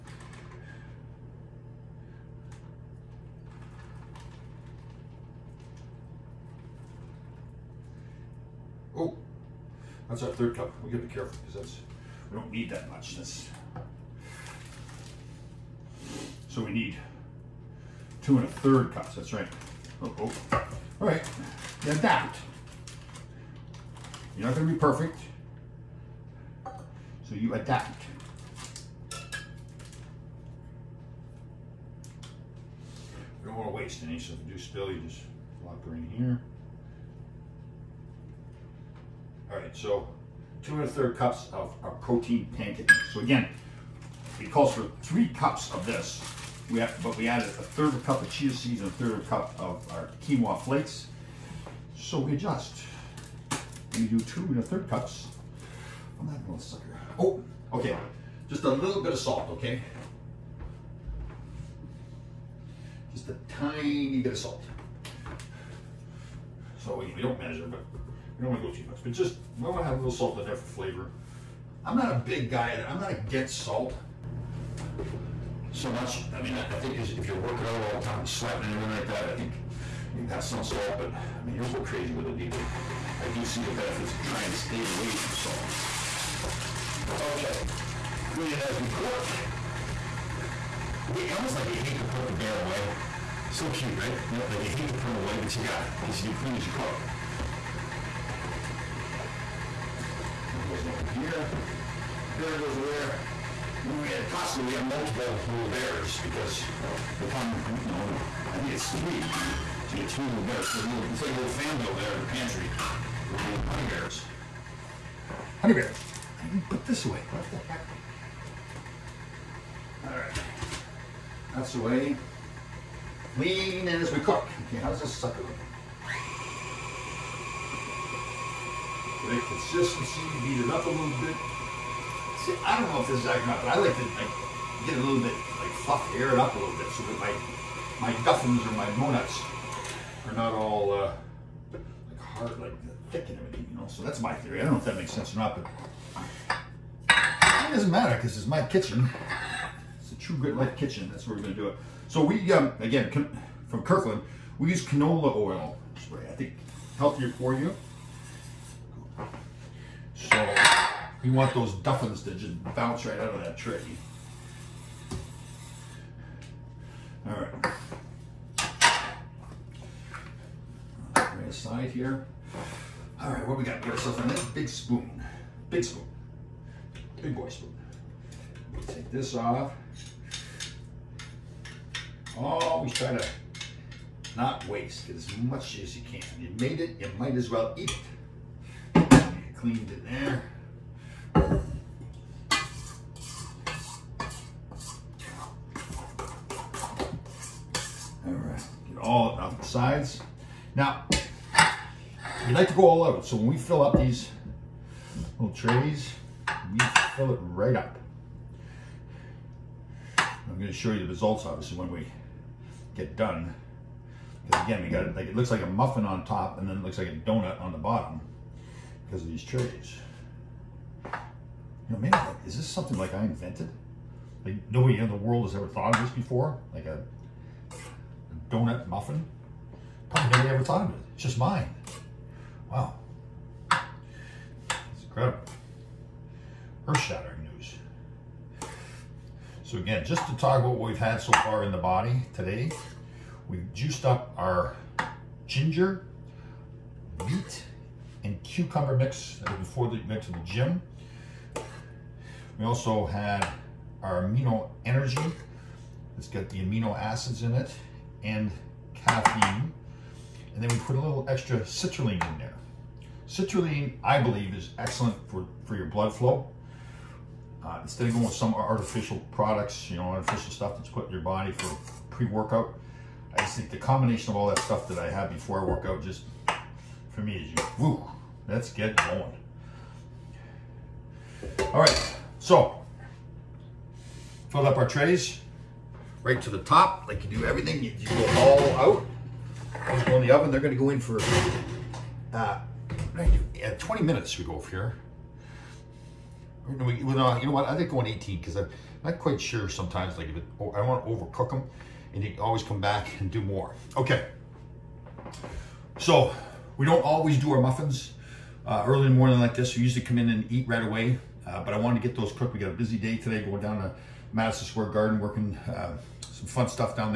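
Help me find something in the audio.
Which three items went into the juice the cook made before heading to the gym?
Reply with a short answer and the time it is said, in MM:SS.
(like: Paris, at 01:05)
ginger, beet, and cucumber, at 04:05.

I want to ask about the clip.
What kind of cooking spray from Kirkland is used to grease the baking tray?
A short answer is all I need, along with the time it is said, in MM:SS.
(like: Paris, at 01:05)
canola oil spray, at 02:34.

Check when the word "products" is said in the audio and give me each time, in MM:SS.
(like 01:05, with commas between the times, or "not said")
04:29.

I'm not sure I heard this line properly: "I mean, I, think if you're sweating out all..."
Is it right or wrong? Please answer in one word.
wrong.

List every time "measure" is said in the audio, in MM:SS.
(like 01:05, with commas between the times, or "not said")
01:07.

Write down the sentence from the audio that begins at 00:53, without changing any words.
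We do two and a third cups.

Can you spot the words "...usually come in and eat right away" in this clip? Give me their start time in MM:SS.
05:09.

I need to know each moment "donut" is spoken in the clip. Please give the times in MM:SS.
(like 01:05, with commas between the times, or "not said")
03:37, 03:48.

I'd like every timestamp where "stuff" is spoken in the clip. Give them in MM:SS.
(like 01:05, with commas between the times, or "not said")
04:30, 04:34.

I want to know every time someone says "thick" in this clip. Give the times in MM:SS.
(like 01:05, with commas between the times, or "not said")
02:23.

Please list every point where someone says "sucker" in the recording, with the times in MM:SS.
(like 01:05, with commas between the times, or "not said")
00:56, 02:05.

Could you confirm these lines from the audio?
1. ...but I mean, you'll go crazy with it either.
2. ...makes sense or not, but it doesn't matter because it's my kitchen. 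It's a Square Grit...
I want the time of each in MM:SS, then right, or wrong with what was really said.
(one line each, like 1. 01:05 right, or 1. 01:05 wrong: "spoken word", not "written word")
1. 01:20 right
2. 02:24 wrong: "True", not "Square".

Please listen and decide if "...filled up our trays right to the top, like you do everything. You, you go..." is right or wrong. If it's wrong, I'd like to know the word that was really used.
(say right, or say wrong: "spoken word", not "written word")
right.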